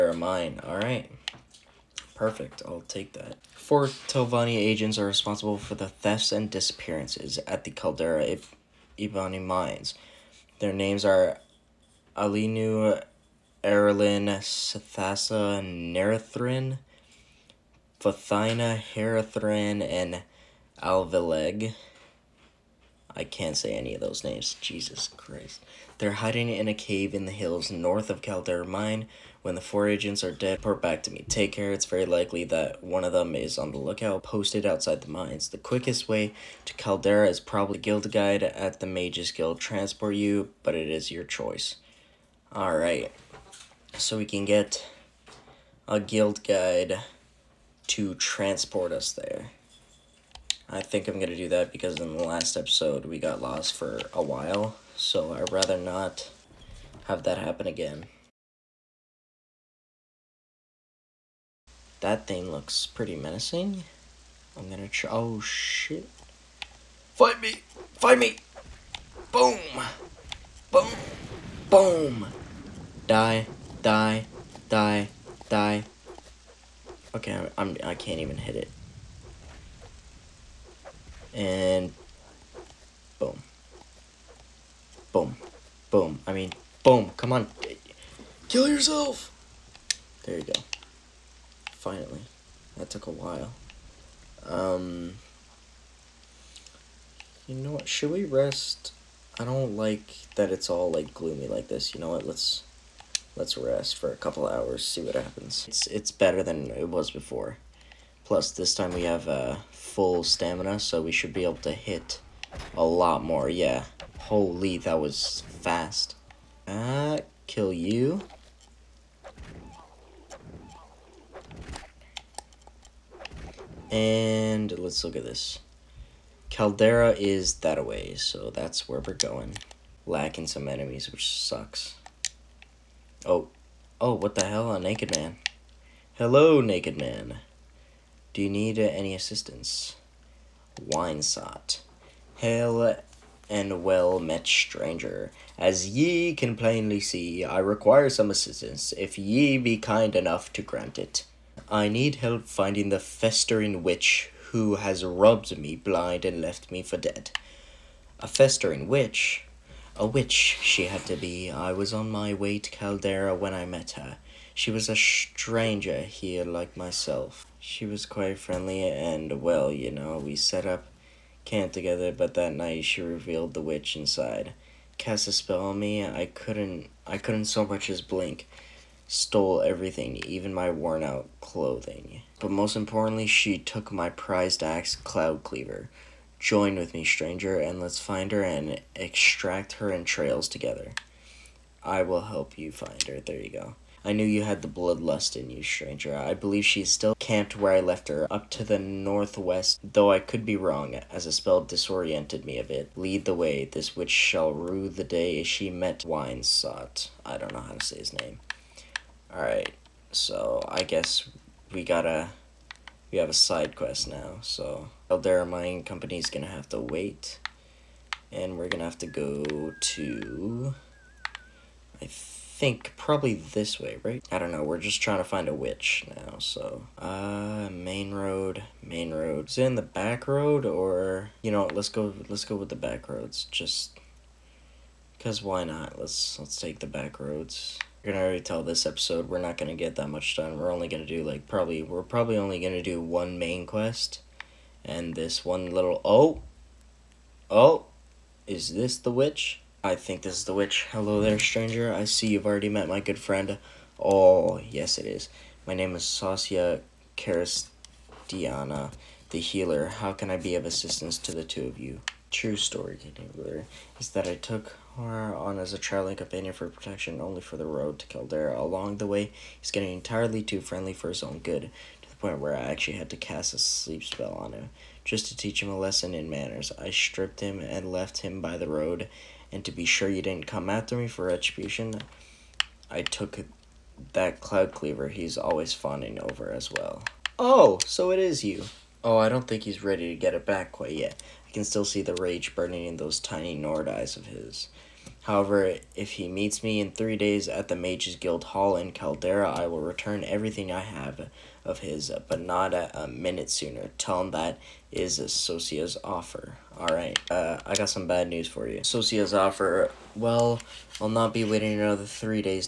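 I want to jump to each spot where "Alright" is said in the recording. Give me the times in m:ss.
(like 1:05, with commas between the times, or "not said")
0:42, 3:29, 5:06.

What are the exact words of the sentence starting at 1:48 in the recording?
Plus, this time we have uh, full stamina, so we should be able to hit a lot more.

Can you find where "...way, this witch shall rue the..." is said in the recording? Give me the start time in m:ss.
3:23.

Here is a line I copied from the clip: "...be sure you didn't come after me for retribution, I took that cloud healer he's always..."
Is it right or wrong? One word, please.
wrong.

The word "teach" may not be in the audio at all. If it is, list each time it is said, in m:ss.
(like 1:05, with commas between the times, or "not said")
4:35.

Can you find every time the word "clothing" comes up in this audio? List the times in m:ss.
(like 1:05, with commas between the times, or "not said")
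3:01.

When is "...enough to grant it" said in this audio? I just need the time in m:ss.
2:30.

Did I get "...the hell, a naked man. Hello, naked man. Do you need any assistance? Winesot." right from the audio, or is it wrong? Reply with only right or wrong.
right.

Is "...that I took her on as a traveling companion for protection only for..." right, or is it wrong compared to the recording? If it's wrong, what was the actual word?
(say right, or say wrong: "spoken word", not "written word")
right.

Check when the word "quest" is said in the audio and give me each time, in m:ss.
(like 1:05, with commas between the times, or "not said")
3:33, 4:03.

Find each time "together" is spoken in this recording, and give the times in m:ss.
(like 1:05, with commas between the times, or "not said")
2:51, 3:10.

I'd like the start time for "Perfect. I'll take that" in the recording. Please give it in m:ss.
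0:02.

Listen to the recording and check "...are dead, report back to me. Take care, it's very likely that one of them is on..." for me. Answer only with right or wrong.
right.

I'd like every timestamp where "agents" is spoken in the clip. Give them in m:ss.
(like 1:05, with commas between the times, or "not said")
0:04, 0:29.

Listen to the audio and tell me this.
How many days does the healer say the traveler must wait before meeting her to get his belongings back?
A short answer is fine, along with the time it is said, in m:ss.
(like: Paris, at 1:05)
3, at 4:56.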